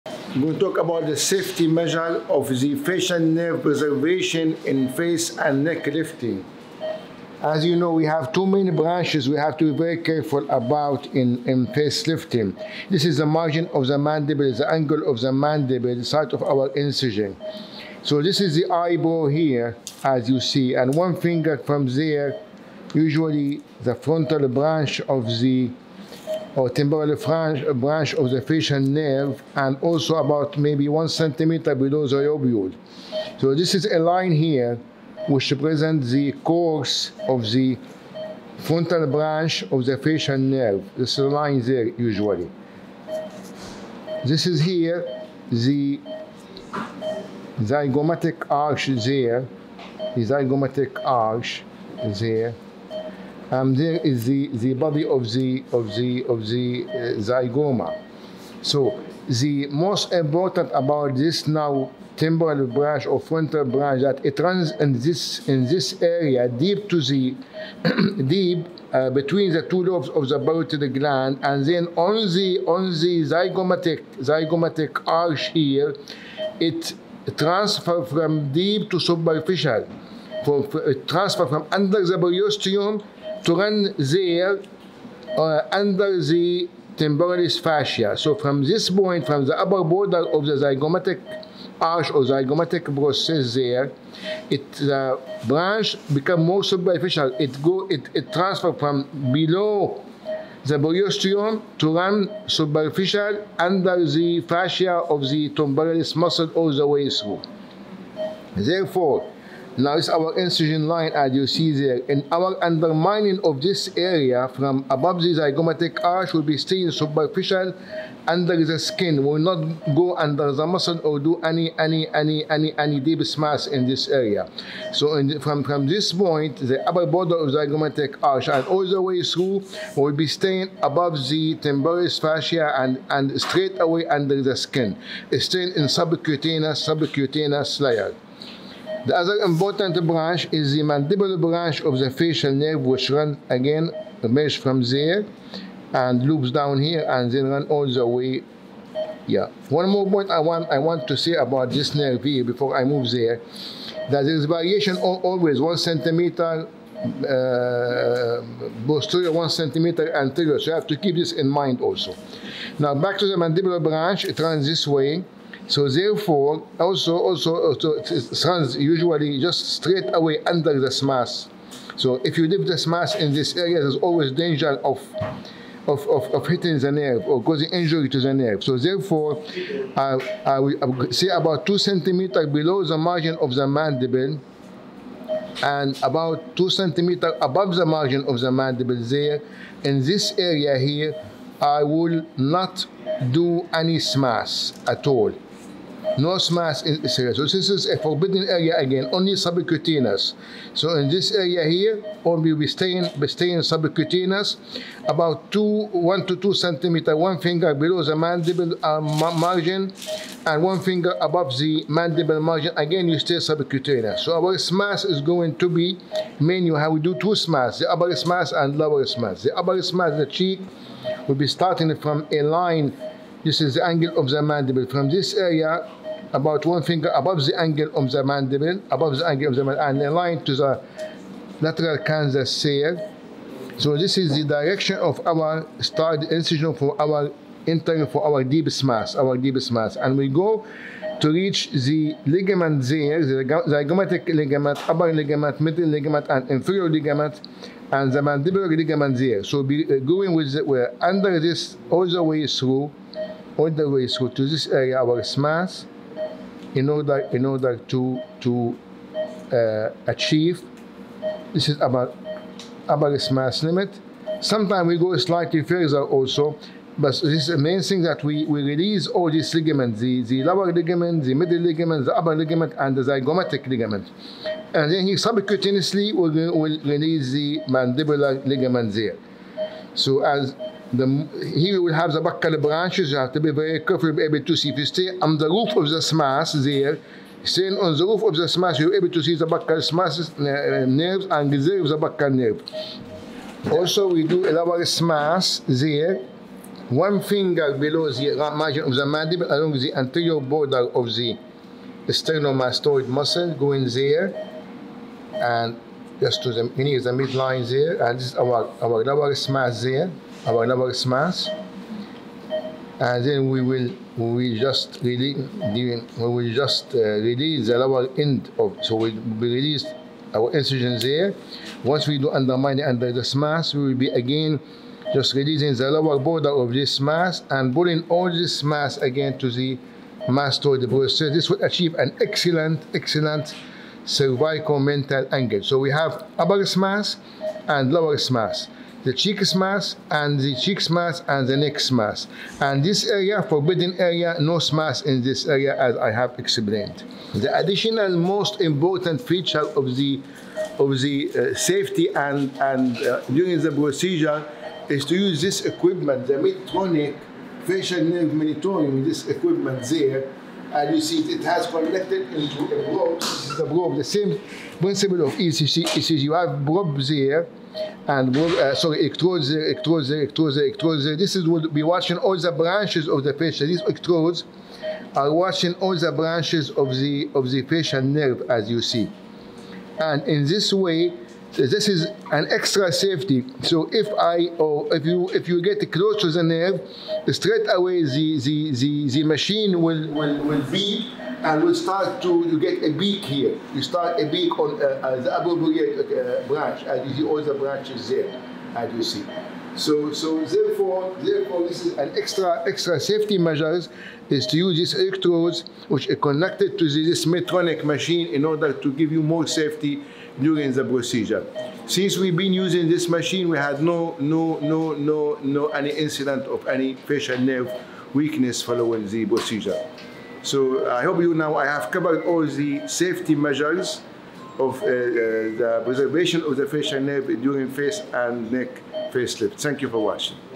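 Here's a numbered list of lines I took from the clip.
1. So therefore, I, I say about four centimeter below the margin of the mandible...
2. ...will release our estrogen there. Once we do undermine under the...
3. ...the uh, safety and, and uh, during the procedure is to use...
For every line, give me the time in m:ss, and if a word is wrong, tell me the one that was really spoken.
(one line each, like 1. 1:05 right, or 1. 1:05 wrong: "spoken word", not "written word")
1. 2:58 wrong: "two", not "four"
2. 5:19 right
3. 5:50 right.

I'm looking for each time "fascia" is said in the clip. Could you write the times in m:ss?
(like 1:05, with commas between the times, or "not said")
1:27, 1:44, 2:12.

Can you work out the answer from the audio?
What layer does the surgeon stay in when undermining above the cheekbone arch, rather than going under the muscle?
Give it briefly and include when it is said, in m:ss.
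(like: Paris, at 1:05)
subcutaneous layer, at 2:15.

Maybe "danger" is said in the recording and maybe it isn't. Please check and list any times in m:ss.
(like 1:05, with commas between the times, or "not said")
2:54.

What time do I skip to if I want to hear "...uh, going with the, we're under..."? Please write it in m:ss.
4:09.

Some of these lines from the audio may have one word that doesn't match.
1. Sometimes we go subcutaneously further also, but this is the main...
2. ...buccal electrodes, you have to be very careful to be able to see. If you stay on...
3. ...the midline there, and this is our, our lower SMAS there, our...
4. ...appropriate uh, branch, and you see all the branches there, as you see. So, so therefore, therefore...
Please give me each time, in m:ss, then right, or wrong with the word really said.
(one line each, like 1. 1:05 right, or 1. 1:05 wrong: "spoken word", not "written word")
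1. 4:24 wrong: "slightly", not "subcutaneously"
2. 4:42 wrong: "branches", not "electrodes"
3. 5:07 right
4. 6:35 right.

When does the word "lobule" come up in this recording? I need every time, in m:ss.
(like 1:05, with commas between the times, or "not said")
0:32.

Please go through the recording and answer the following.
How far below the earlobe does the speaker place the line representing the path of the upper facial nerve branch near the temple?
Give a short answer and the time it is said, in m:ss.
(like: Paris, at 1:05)
1 centimeter, at 0:30.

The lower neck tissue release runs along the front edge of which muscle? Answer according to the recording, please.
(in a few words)
sternomastoid.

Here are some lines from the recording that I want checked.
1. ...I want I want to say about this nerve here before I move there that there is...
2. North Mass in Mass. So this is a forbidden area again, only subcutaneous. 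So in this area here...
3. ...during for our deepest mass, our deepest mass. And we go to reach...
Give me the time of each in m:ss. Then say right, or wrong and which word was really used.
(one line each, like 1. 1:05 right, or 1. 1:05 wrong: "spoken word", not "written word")
1. 2:30 right
2. 3:16 wrong: "Israel", not "Mass"
3. 3:57 wrong: "entering", not "during".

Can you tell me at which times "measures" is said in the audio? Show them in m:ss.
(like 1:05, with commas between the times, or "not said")
0:01, 6:43, 7:03.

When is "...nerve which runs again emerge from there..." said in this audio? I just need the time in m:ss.
2:22.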